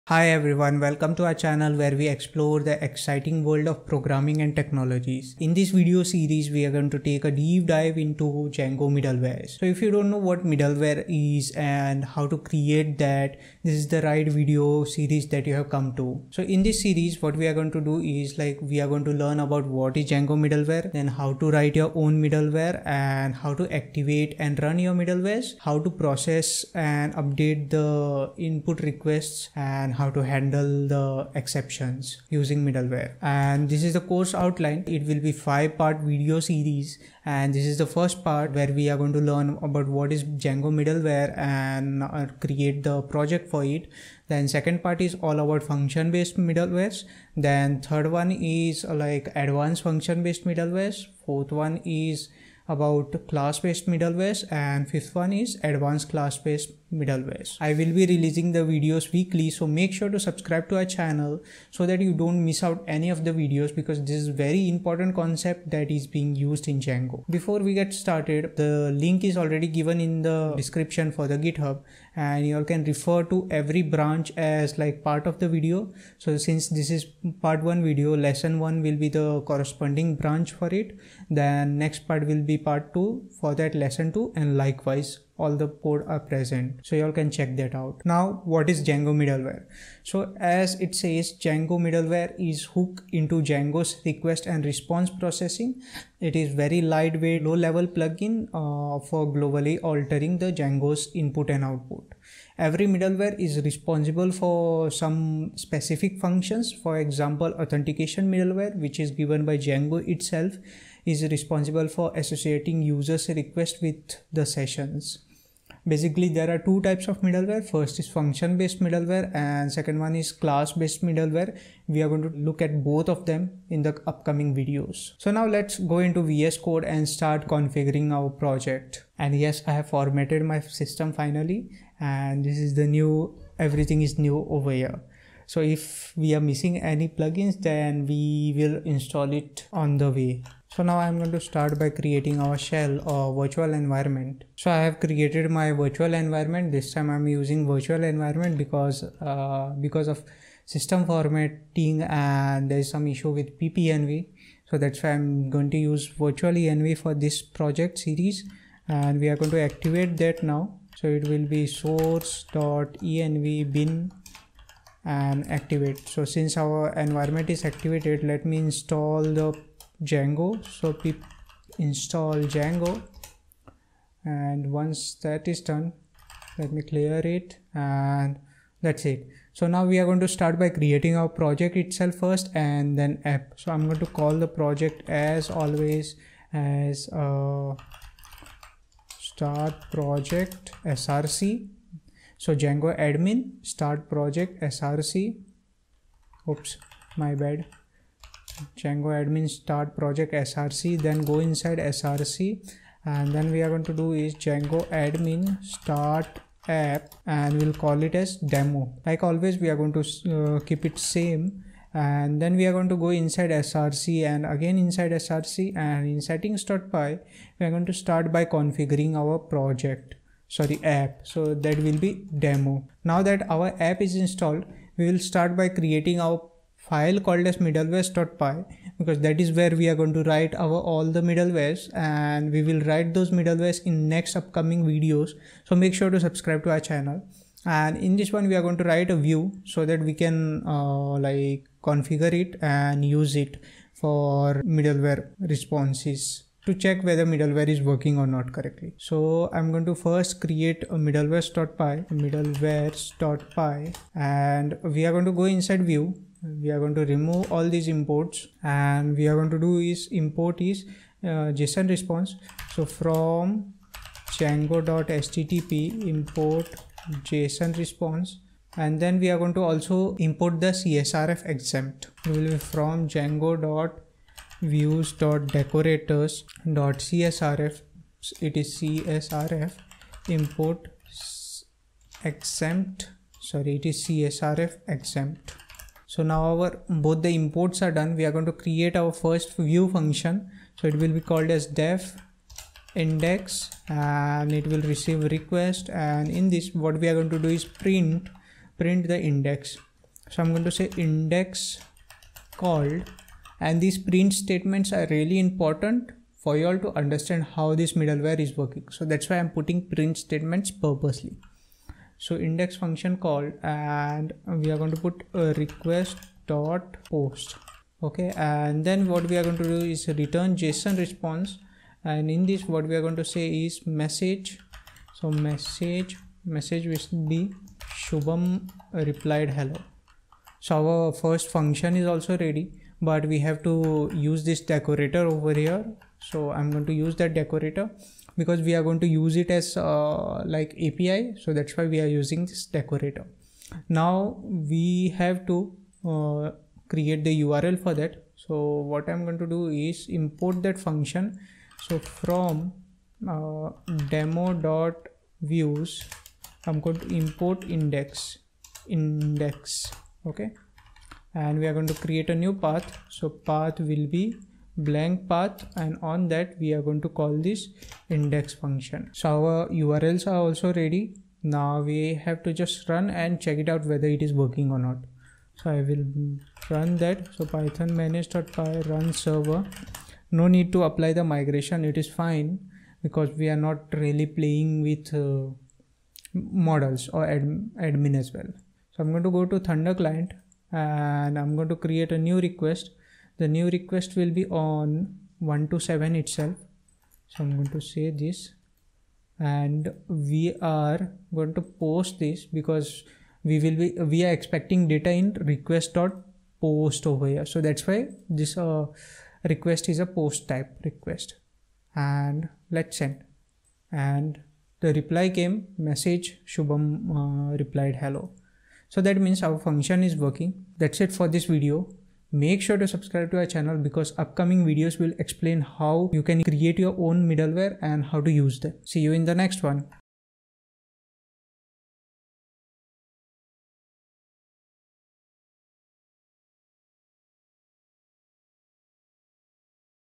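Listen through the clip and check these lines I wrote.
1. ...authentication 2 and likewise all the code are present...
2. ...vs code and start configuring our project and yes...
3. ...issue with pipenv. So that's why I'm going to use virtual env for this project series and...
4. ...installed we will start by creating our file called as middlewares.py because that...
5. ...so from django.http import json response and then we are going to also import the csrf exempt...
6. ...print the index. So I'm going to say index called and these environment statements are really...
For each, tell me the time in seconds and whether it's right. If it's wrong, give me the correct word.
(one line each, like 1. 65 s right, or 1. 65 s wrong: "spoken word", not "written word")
1. 83 s wrong: "lesson", not "authentication"
2. 126 s right
3. 153 s right
4. 224 s right
5. 262 s right
6. 298 s wrong: "print", not "environment".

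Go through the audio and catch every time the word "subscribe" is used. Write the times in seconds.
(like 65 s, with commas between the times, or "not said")
60 s, 236 s, 422 s.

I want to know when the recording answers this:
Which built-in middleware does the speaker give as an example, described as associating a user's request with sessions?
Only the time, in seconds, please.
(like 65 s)
107 s.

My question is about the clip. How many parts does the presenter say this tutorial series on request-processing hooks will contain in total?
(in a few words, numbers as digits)
5.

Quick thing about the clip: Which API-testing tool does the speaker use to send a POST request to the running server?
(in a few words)
Thunder Client.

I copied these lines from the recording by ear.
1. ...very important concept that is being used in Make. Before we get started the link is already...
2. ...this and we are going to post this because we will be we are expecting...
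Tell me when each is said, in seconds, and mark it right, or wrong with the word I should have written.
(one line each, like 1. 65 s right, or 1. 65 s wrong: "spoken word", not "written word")
1. 64 s wrong: "Django", not "Make"
2. 398 s right.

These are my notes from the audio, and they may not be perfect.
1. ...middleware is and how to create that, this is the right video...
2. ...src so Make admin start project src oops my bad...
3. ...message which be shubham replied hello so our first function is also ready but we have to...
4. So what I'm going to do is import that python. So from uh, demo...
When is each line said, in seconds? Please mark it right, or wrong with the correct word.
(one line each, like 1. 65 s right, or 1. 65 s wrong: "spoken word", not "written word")
1. 10 s right
2. 190 s wrong: "Django", not "Make"
3. 326 s right
4. 348 s wrong: "function", not "python".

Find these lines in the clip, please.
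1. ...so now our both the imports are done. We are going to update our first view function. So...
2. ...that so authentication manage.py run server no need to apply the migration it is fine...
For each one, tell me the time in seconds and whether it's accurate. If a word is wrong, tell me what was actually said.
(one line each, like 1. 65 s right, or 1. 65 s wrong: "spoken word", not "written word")
1. 286 s wrong: "create", not "update"
2. 376 s wrong: "python", not "authentication".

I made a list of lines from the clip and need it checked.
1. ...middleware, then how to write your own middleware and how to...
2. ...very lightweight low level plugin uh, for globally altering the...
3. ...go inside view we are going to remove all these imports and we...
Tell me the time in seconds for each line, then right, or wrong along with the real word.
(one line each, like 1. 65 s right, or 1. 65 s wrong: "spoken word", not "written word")
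1. 20 s right
2. 96 s right
3. 255 s right.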